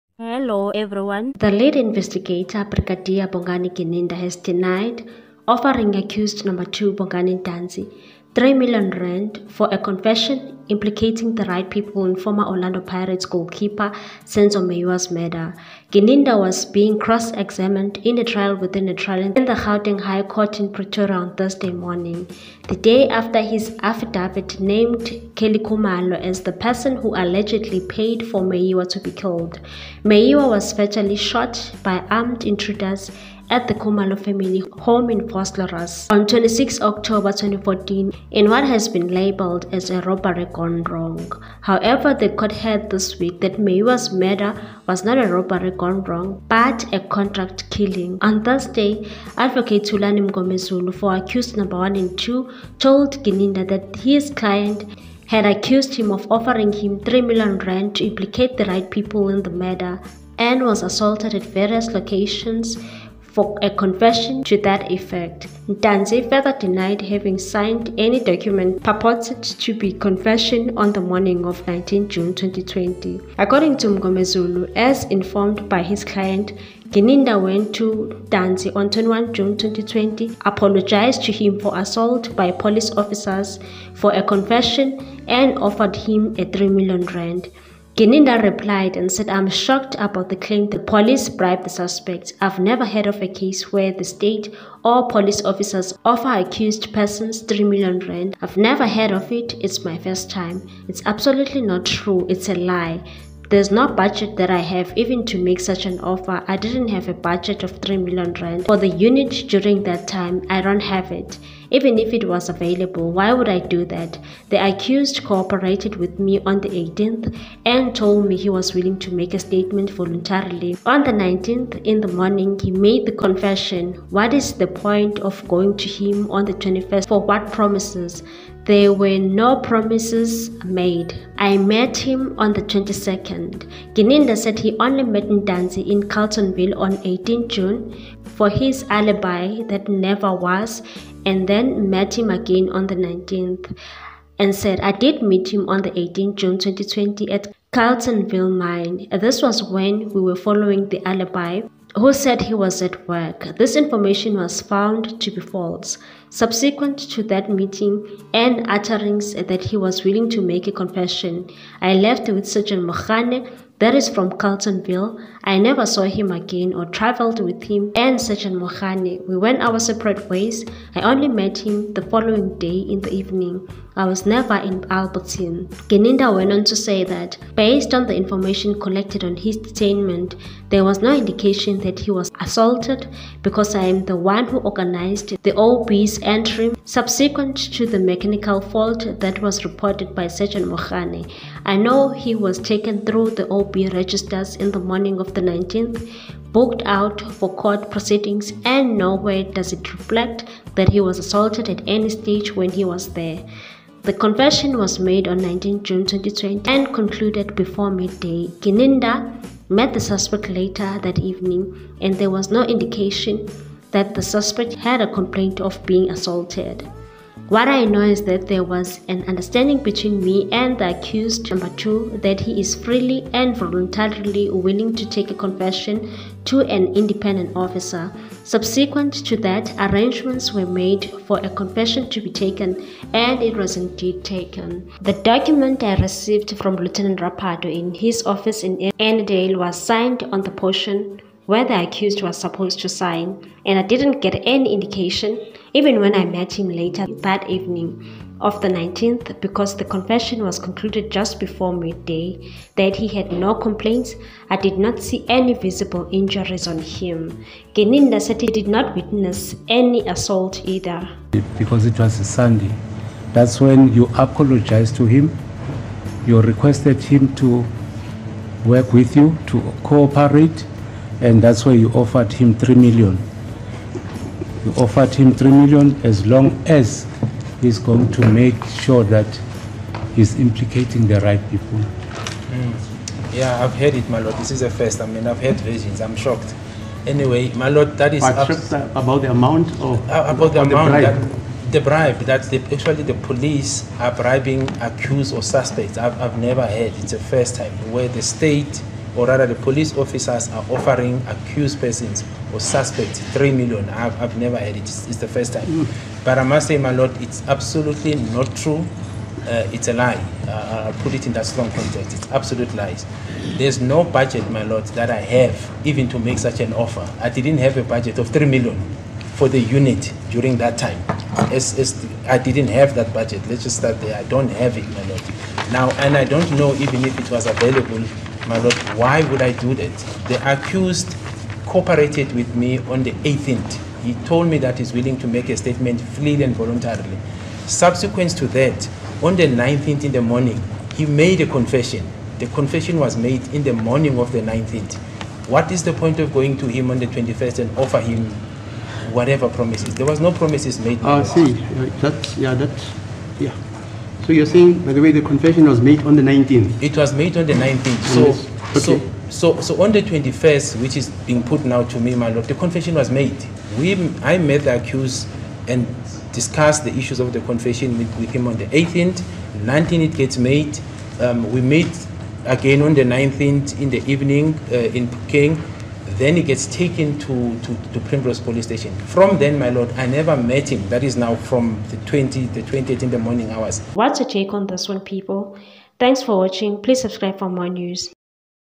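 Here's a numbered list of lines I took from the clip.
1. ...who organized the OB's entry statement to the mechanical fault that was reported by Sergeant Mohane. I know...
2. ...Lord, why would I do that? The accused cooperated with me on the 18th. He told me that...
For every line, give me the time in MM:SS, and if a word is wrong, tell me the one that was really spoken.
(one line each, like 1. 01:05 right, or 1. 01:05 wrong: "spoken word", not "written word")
1. 03:04 wrong: "subsequent", not "statement"
2. 05:28 right.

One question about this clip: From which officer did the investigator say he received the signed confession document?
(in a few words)
Lieutenant Rapardo.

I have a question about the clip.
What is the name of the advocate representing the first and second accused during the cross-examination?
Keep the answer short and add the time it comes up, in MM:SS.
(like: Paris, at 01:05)
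Thulani Mngomezulu, at 00:49.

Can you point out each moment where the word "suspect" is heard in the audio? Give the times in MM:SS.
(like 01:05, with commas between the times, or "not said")
01:31, 03:29, 03:34, 04:55, 05:02.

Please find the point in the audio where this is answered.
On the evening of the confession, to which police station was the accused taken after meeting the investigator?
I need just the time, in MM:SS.
06:18.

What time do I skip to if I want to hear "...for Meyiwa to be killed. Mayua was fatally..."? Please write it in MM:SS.
00:28.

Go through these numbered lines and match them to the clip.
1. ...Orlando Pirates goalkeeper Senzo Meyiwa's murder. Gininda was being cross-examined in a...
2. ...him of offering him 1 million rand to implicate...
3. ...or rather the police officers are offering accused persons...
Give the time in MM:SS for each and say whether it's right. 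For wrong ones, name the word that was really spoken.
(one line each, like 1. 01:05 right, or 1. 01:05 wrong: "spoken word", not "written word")
1. 00:12 right
2. 00:55 wrong: "3", not "1"
3. 04:59 right.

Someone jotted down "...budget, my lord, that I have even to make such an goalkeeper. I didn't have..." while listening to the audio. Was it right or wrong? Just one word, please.
wrong.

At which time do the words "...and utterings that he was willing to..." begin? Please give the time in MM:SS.
02:38.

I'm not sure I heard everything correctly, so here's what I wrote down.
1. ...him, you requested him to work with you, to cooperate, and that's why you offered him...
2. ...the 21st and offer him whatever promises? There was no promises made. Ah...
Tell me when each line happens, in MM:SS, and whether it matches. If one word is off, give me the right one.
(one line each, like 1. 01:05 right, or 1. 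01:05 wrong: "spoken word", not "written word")
1. 04:25 right
2. 05:46 right.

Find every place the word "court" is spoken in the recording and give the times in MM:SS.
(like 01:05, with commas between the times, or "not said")
00:20, 00:42, 03:17.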